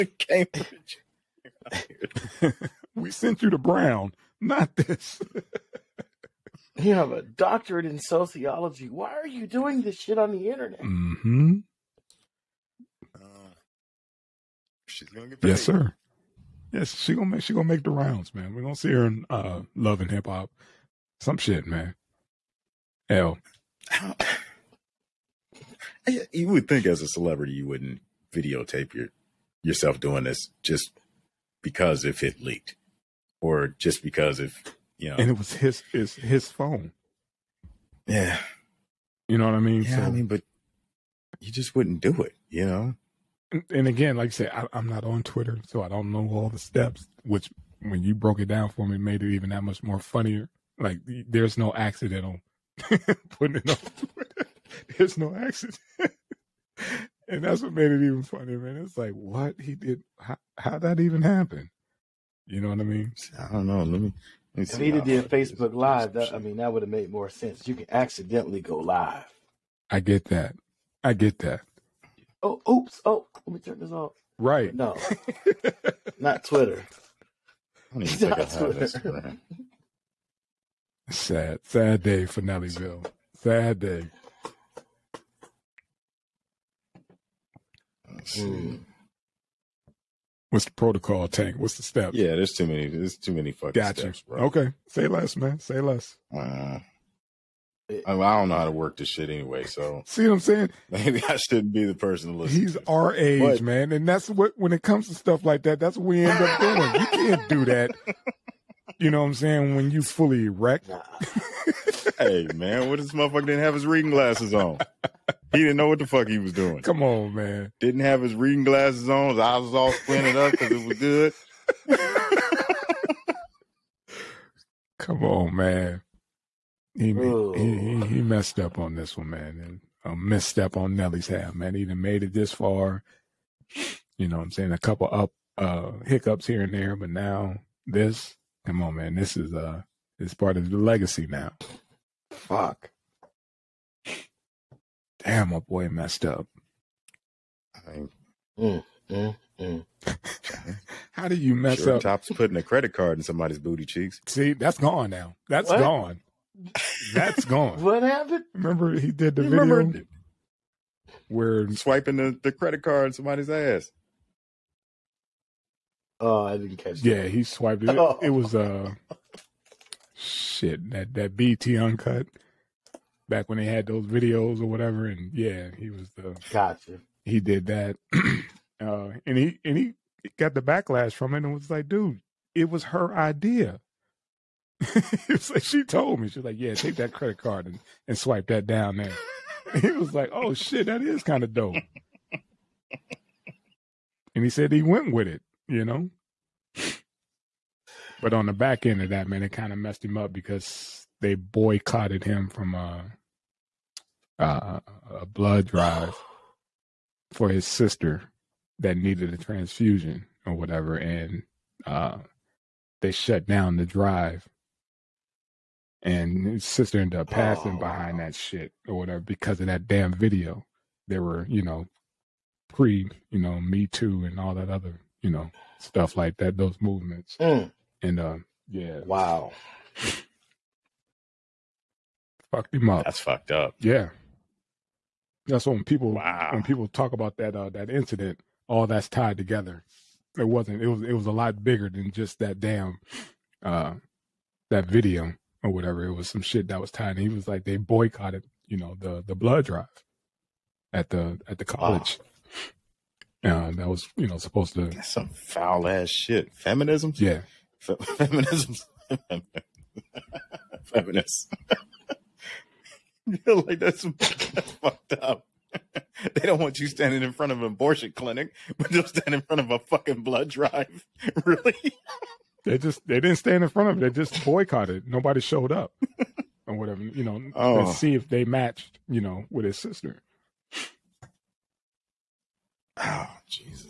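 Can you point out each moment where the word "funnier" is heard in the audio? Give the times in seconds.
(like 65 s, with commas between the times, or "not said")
49 s, 58 s.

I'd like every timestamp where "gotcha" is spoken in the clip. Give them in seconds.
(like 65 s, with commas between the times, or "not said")
93 s, 176 s.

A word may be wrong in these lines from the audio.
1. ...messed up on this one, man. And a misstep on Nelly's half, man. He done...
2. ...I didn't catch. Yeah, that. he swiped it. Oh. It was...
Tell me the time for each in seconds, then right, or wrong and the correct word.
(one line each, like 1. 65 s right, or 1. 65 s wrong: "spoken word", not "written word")
1. 128 s right
2. 166 s right.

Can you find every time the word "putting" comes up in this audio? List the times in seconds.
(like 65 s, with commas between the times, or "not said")
53 s, 152 s.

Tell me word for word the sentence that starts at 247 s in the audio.
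And he was like, they boycotted, you know, the the blood drive at the at the college.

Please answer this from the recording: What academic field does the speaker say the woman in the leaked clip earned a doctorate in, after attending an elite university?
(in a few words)
Sociology.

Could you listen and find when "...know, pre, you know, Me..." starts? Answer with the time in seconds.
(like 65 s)
221 s.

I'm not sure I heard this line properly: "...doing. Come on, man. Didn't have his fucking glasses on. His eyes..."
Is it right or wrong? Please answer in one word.
wrong.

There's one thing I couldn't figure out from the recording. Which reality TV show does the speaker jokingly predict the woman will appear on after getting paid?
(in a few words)
Love and Hip Hop.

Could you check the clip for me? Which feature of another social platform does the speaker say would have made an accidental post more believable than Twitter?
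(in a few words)
Facebook Live.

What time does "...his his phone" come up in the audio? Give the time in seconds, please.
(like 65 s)
35 s.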